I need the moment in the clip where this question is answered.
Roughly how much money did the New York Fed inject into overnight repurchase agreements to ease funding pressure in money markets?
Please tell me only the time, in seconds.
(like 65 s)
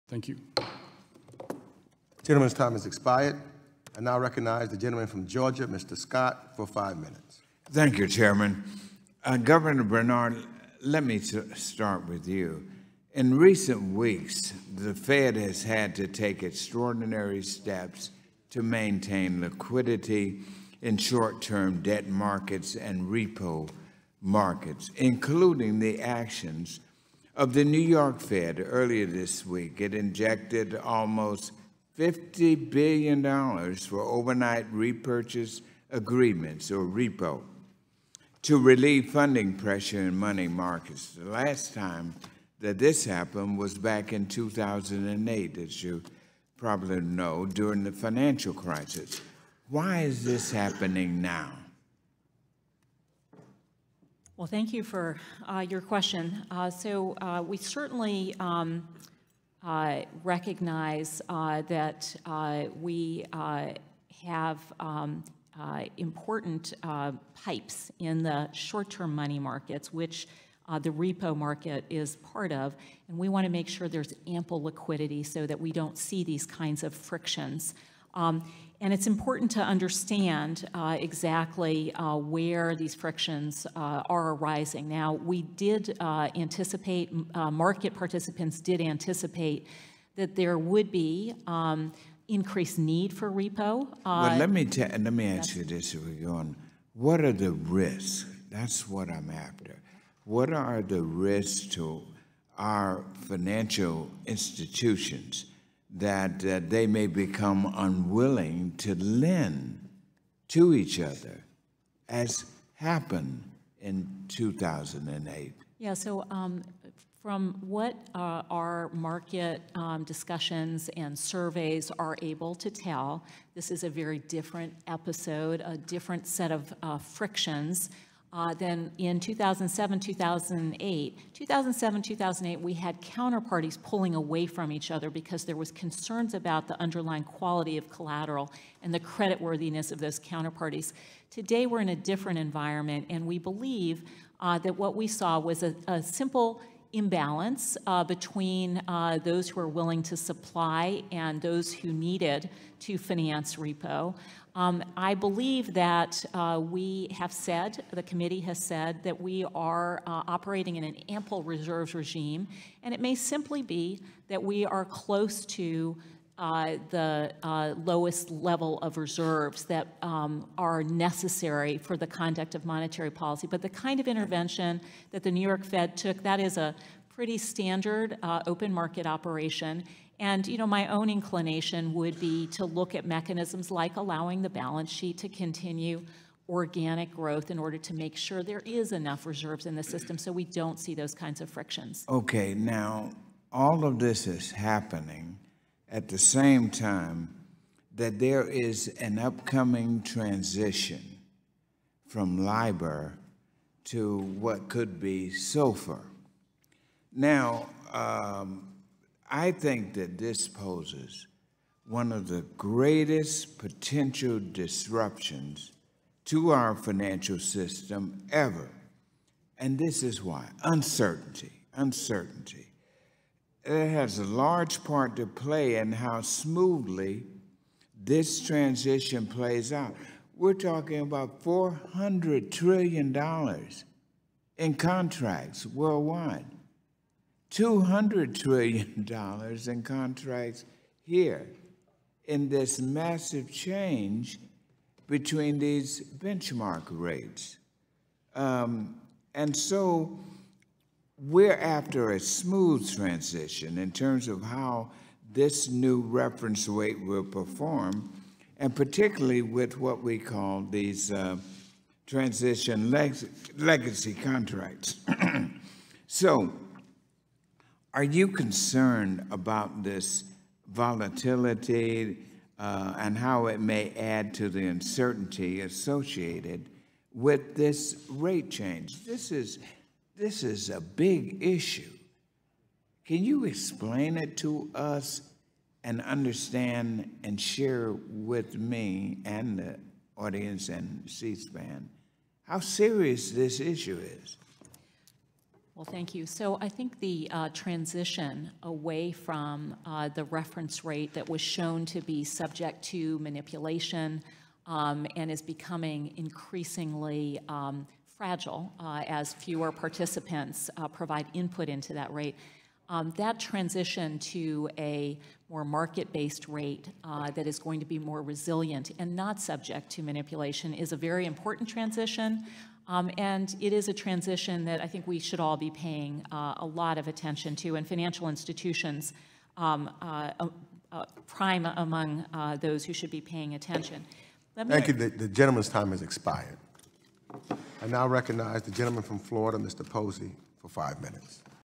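31 s.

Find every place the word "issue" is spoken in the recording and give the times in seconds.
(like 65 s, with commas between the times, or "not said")
281 s, 293 s.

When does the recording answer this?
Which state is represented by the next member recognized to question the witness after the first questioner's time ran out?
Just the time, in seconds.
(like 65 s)
339 s.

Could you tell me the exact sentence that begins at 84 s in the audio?
Now, we did uh, anticipate, uh, market participants did anticipate that there would be um, increased need for repo.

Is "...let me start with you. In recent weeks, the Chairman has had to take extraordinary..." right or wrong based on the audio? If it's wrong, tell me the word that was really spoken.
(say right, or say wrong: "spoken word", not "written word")
wrong: "Fed", not "Chairman".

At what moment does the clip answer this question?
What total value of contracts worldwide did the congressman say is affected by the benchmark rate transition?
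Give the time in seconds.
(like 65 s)
231 s.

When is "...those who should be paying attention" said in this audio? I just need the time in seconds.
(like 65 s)
332 s.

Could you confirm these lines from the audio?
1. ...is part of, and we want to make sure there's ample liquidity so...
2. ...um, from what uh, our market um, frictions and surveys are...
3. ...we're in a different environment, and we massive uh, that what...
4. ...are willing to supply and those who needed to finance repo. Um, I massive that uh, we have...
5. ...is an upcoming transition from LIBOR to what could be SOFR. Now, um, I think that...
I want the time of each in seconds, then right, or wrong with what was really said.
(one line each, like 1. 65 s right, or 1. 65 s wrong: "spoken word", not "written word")
1. 71 s right
2. 116 s wrong: "discussions", not "frictions"
3. 141 s wrong: "believe", not "massive"
4. 149 s wrong: "believe", not "massive"
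5. 198 s right.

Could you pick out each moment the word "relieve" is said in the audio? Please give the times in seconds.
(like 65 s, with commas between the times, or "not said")
38 s.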